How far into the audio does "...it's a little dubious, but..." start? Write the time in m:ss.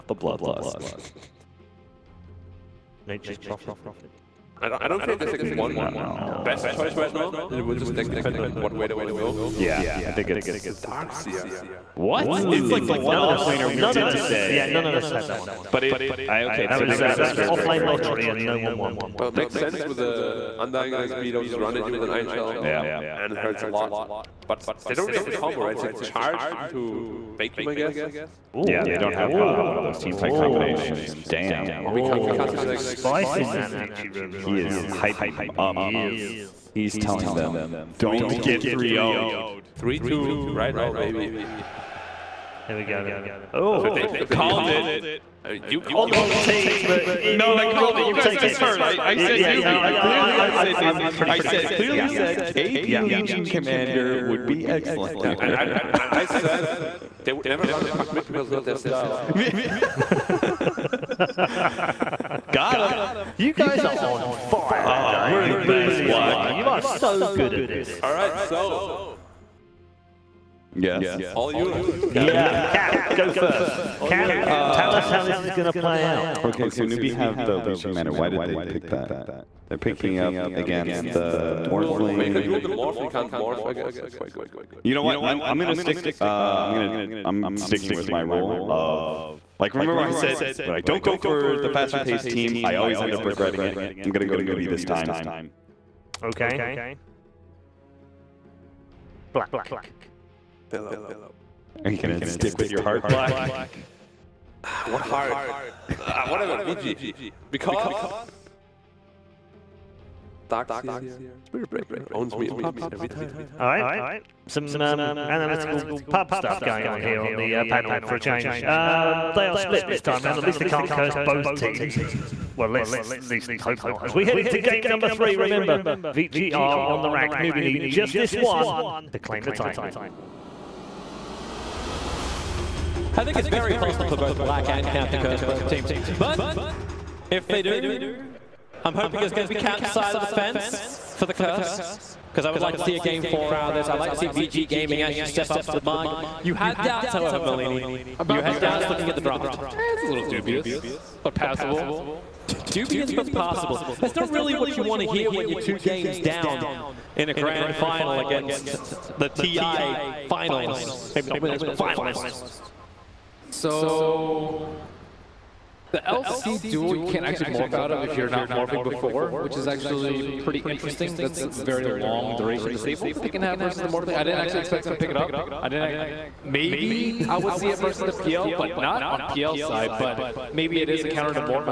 2:29.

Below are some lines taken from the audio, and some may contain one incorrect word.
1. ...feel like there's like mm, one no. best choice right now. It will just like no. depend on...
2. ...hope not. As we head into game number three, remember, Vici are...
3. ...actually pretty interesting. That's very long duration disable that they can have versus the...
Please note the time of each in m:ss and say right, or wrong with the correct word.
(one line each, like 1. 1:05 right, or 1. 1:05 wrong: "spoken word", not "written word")
1. 0:05 right
2. 2:03 right
3. 2:49 right.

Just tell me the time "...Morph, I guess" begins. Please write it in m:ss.
1:23.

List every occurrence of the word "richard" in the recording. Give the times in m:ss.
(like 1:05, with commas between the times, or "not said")
not said.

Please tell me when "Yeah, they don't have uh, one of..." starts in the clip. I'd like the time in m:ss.
0:28.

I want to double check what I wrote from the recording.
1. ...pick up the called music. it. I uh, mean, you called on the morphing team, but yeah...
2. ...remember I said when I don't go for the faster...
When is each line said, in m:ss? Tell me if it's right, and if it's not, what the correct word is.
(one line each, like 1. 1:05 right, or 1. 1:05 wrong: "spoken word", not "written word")
1. 0:44 wrong: "wrong", not "morphing"
2. 1:29 right.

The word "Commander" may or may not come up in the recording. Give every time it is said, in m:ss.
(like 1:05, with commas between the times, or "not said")
0:53, 1:17.